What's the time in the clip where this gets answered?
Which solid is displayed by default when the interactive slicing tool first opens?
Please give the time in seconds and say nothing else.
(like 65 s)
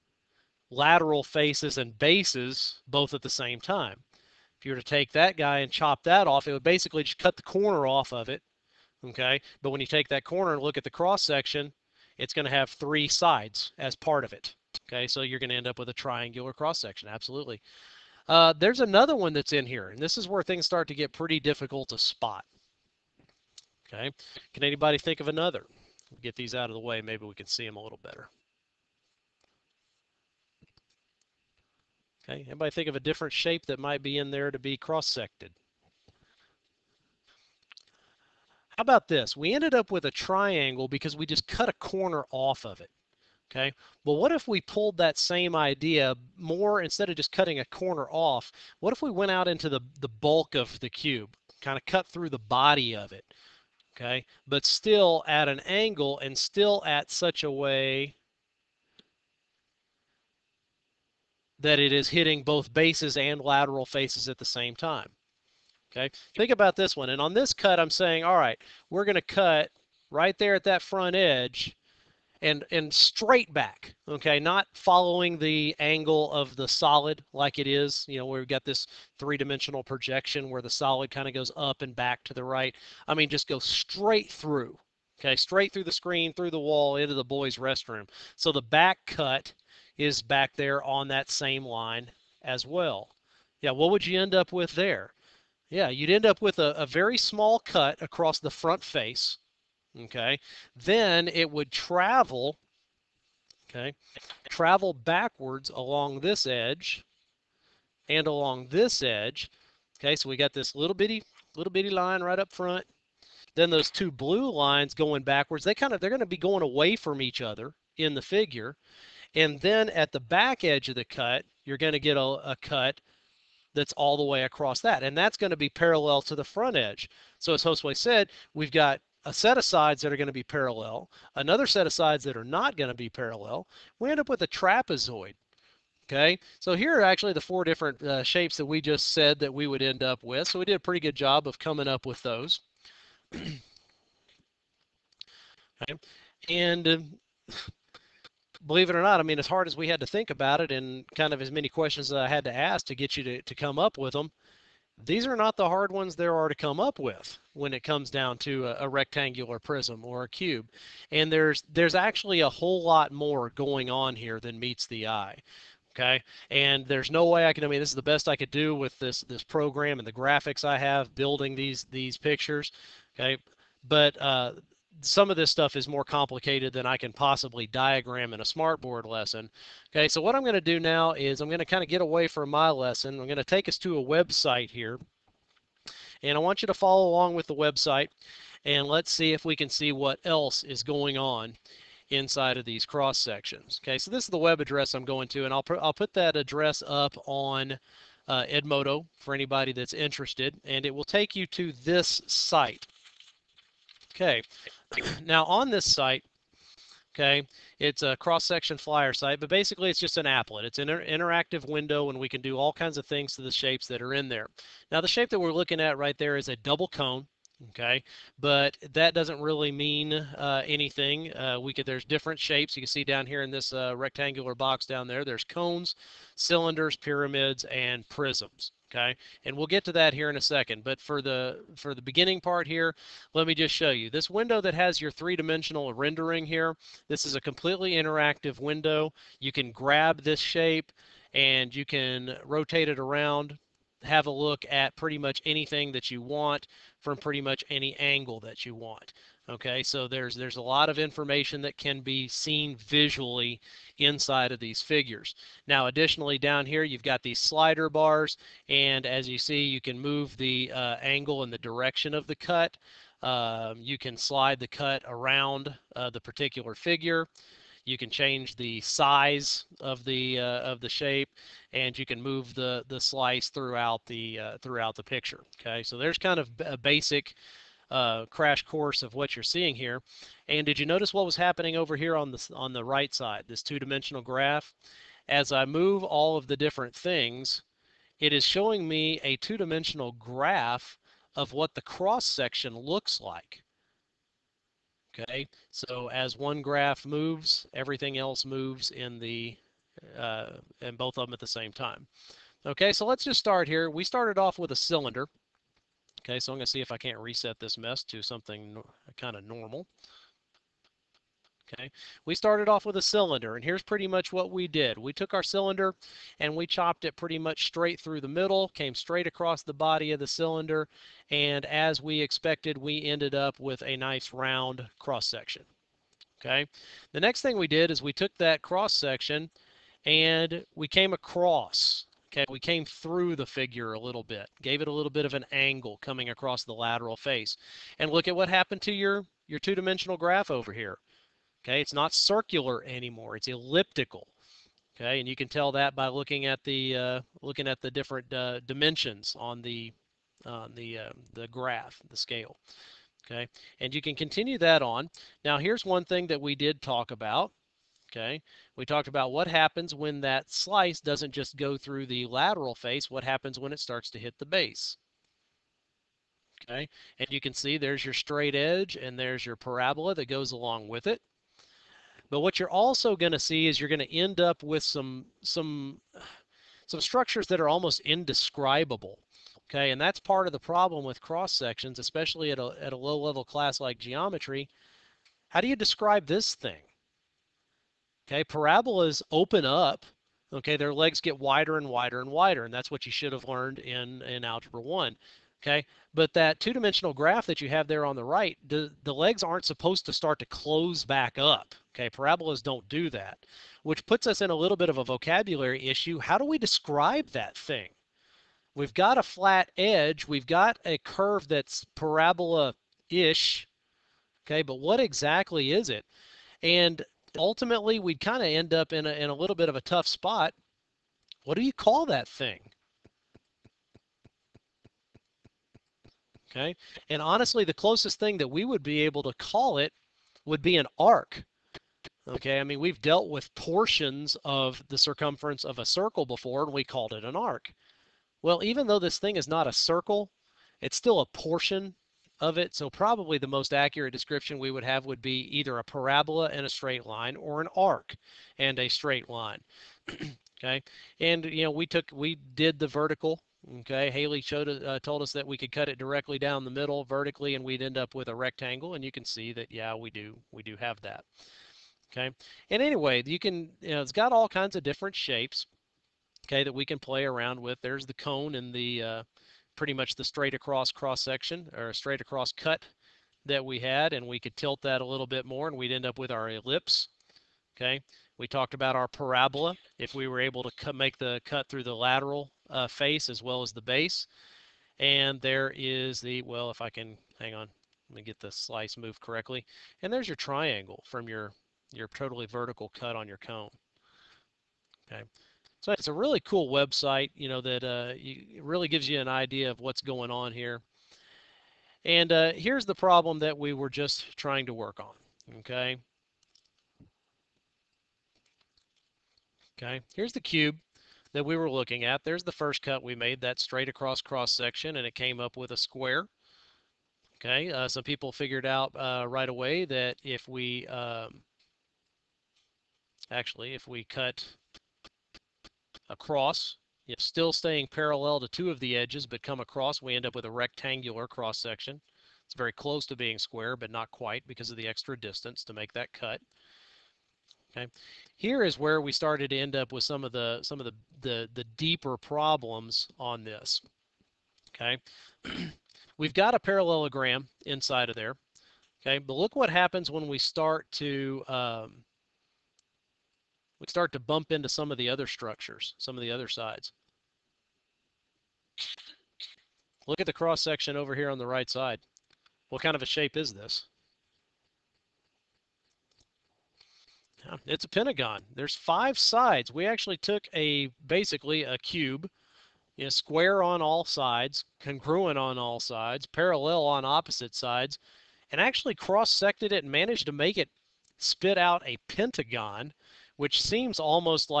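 216 s.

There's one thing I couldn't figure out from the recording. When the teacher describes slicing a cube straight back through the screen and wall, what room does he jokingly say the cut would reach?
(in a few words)
the boys' restroom.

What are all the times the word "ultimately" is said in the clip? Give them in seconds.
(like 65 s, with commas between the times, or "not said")
417 s.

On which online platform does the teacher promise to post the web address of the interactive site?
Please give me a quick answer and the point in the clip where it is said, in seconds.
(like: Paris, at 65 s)
Edmodo, at 198 s.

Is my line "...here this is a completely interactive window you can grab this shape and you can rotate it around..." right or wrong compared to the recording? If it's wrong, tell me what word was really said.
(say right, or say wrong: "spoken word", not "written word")
right.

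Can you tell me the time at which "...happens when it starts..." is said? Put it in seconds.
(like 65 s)
363 s.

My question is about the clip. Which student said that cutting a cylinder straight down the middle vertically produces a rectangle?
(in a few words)
Haley.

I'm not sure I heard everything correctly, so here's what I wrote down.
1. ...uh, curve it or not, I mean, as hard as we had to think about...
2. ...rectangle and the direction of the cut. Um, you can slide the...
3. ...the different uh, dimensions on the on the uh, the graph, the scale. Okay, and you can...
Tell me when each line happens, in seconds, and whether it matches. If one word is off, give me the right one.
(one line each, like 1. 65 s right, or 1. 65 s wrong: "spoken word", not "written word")
1. 146 s wrong: "believe", not "curve"
2. 261 s wrong: "angle", not "rectangle"
3. 347 s right.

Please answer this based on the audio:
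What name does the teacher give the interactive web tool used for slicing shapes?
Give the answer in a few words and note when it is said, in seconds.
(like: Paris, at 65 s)
cross-section flyer, at 208 s.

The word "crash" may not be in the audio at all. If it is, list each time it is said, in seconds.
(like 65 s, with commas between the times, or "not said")
278 s.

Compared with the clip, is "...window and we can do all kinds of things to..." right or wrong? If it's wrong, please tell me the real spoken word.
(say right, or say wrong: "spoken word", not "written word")
right.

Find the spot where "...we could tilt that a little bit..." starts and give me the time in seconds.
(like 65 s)
474 s.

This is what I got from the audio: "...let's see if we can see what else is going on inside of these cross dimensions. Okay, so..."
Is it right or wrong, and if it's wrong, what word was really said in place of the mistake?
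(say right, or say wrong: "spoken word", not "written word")
wrong: "sections", not "dimensions".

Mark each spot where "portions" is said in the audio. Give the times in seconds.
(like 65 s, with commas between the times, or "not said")
433 s, 441 s.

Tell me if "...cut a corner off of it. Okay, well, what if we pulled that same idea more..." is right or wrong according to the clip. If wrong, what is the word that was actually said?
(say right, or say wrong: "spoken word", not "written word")
right.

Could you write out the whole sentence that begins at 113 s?
Then those two blue lines going backwards, they kind of they're going to be going away from each other in the figure.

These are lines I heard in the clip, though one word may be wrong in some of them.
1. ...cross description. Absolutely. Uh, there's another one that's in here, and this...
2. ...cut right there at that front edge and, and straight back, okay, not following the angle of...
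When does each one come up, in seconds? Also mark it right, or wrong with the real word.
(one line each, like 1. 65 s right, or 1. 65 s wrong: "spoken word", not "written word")
1. 16 s wrong: "section", not "description"
2. 69 s right.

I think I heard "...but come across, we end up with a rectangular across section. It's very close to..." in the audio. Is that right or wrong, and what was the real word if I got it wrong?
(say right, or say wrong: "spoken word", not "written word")
wrong: "cross", not "across".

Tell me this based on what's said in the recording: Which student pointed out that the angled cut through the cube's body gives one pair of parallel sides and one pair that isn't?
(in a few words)
Hostway.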